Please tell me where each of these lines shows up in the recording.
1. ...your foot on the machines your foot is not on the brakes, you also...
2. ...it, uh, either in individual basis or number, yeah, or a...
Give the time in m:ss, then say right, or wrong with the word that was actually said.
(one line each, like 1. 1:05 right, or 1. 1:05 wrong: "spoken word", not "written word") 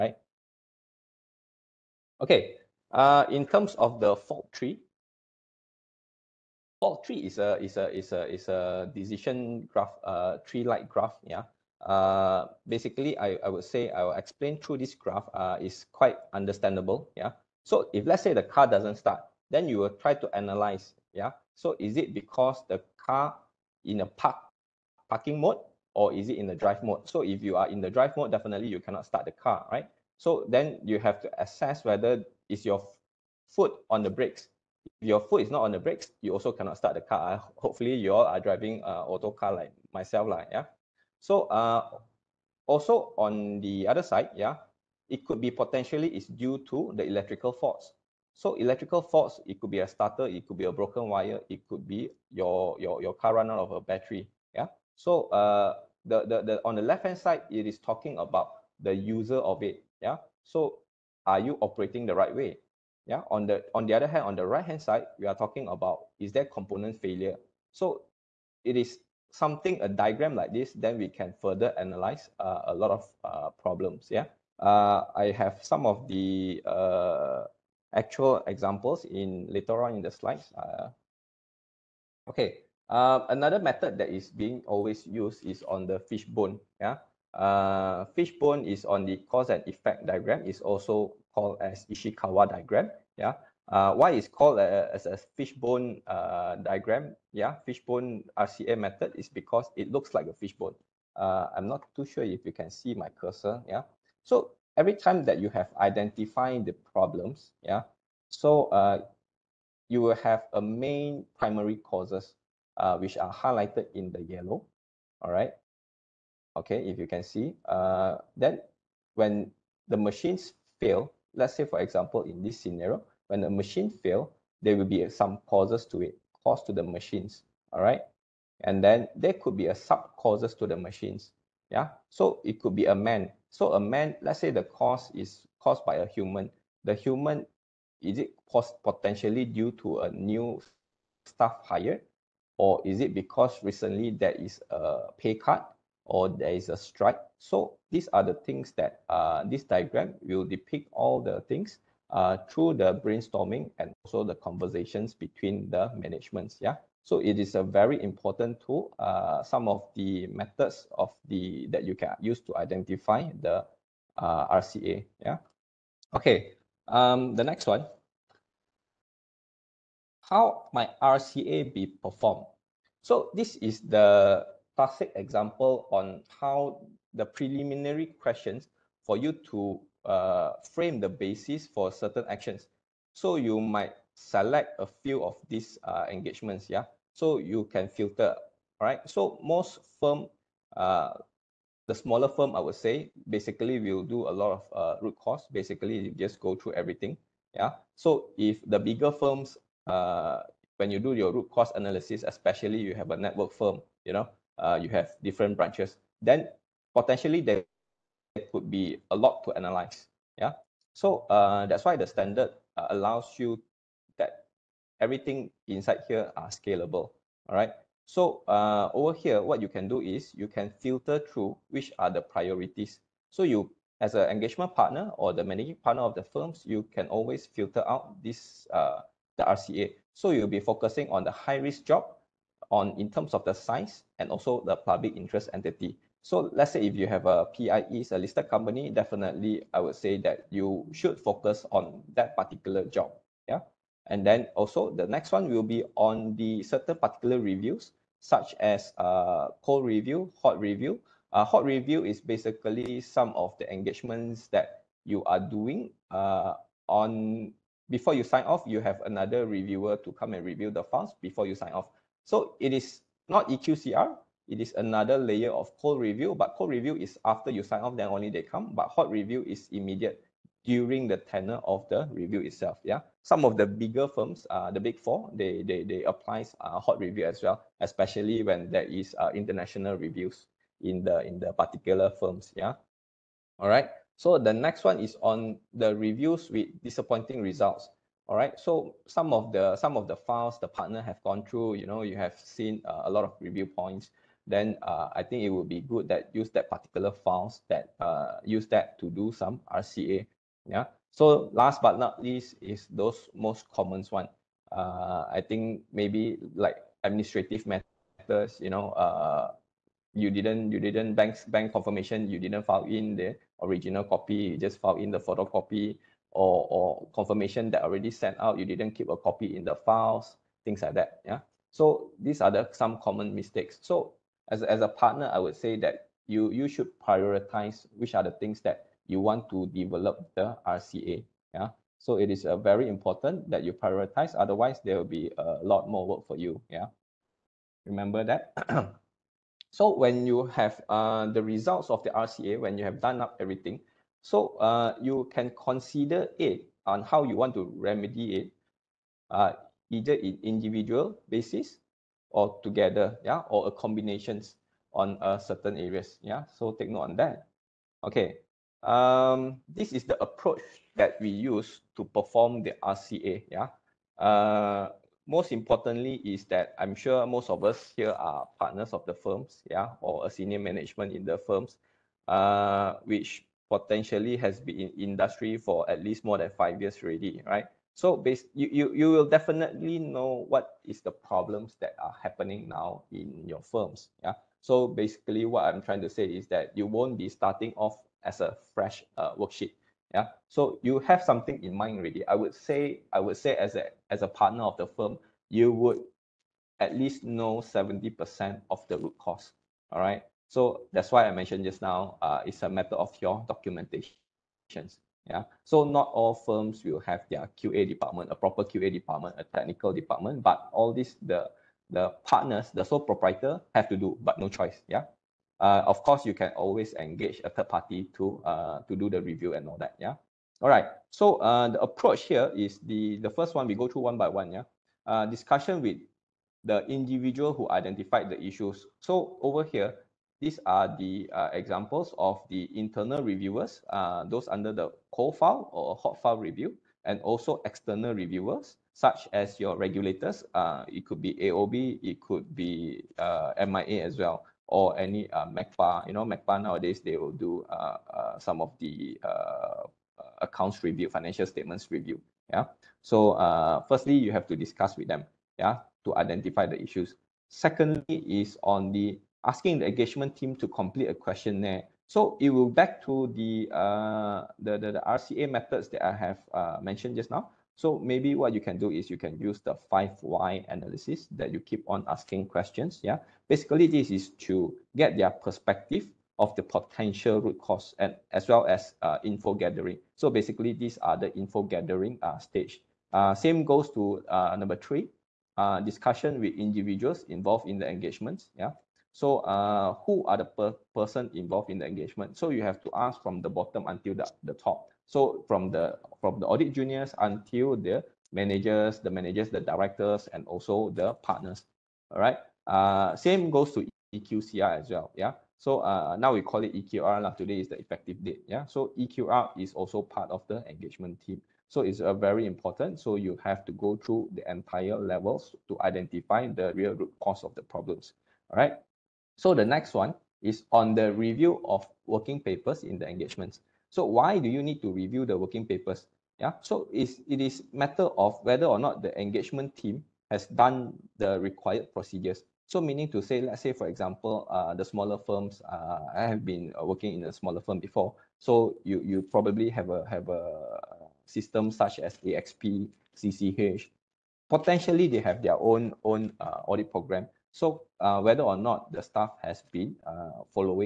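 1. 0:32 wrong: "brakes", not "machines"
2. 5:48 wrong: "together", not "number".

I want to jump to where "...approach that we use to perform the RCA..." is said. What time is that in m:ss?
6:00.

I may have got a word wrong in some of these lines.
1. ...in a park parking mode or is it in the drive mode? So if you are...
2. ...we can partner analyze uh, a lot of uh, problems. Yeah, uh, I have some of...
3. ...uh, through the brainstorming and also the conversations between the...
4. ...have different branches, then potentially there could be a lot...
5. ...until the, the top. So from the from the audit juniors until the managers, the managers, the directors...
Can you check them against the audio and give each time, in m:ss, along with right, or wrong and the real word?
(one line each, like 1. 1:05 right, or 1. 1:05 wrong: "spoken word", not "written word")
1. 0:23 right
2. 1:10 wrong: "further", not "partner"
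3. 2:32 right
4. 3:24 right
5. 8:13 right.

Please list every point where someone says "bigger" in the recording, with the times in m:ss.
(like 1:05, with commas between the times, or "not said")
3:18, 4:33.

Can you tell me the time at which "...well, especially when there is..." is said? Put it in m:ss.
4:37.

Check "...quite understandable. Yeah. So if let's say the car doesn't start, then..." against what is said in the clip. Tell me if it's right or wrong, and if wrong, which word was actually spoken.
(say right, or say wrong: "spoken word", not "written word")
right.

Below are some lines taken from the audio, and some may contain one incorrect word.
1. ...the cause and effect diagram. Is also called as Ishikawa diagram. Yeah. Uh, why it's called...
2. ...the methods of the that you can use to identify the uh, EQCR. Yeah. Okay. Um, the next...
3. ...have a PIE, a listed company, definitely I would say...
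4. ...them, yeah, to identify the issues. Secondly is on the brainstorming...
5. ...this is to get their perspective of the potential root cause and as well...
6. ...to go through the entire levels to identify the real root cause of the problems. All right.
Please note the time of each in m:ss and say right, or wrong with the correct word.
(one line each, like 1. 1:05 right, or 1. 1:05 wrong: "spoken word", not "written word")
1. 1:29 right
2. 2:39 wrong: "RCA", not "EQCR"
3. 3:57 right
4. 7:35 wrong: "asking", not "brainstorming"
5. 7:53 right
6. 8:33 right.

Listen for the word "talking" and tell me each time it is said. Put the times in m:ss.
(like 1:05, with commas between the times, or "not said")
0:57, 1:05.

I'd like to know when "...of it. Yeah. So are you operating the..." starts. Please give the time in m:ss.
0:59.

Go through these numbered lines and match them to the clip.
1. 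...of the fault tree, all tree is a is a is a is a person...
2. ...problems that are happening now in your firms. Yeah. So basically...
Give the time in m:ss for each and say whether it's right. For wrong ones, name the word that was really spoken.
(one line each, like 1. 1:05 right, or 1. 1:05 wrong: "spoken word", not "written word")
1. 0:03 wrong: "decision", not "person"
2. 6:21 right.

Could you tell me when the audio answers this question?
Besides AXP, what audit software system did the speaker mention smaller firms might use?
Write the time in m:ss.
9:03.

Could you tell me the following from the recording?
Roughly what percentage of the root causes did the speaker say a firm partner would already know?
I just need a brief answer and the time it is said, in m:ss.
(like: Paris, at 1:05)
70%, at 6:37.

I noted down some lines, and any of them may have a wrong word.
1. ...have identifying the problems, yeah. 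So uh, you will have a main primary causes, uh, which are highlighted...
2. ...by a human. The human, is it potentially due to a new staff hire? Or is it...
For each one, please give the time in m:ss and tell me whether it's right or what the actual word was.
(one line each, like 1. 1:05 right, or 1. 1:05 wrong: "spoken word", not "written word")
1. 1:45 right
2. 2:15 right.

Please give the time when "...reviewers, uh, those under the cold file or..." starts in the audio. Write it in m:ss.
7:13.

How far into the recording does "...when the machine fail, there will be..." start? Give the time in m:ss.
2:03.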